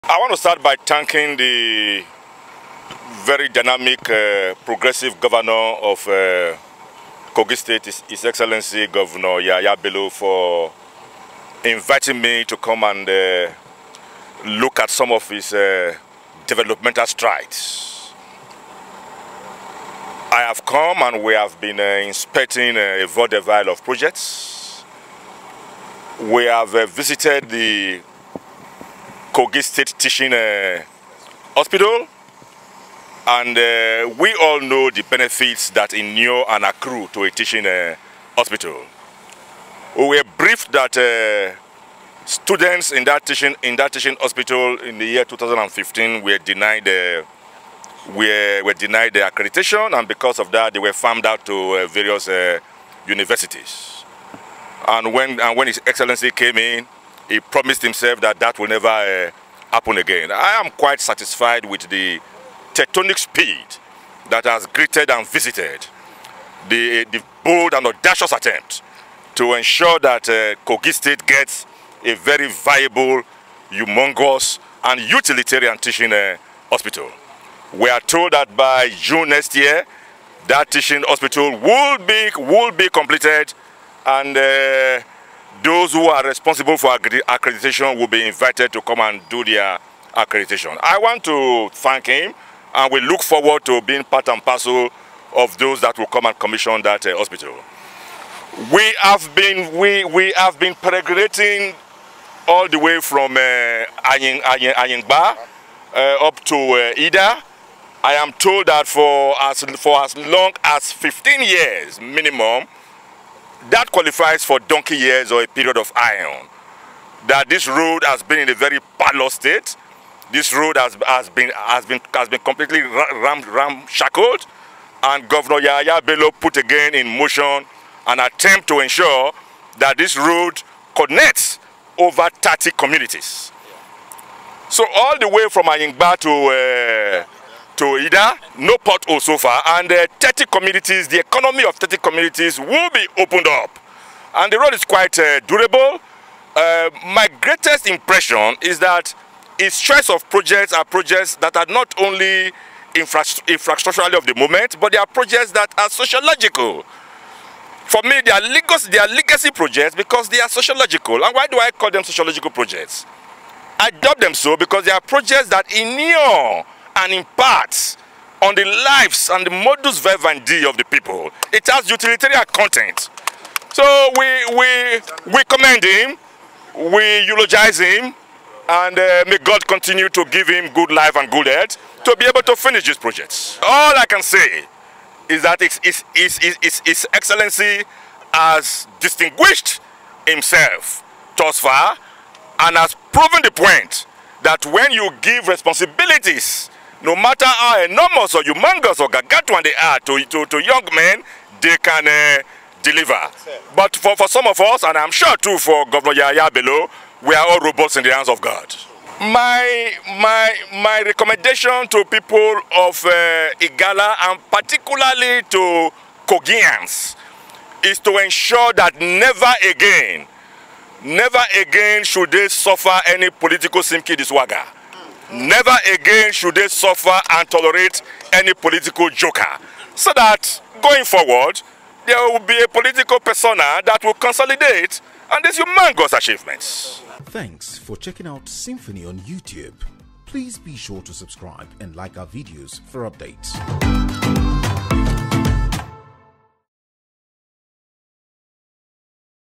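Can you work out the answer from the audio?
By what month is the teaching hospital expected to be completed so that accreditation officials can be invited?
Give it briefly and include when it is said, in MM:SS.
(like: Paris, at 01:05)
June, at 01:18.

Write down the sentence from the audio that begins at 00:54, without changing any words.
And when, and when His Excellency came in, he promised himself that that will never uh, happen again.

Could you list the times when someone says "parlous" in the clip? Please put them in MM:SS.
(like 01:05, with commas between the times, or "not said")
01:58.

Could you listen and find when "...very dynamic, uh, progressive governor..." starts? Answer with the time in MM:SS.
00:03.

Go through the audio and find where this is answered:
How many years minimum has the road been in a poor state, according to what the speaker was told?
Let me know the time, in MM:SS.
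01:50.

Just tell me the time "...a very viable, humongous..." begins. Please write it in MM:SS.
01:12.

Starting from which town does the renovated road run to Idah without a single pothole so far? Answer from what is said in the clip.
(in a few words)
Ayingba.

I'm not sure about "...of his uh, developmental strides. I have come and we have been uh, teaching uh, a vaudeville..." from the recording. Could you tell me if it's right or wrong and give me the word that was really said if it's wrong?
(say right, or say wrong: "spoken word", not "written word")
wrong: "inspecting", not "teaching".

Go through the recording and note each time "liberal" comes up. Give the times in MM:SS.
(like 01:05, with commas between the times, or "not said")
not said.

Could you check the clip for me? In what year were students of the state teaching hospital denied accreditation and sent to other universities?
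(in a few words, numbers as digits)
2015.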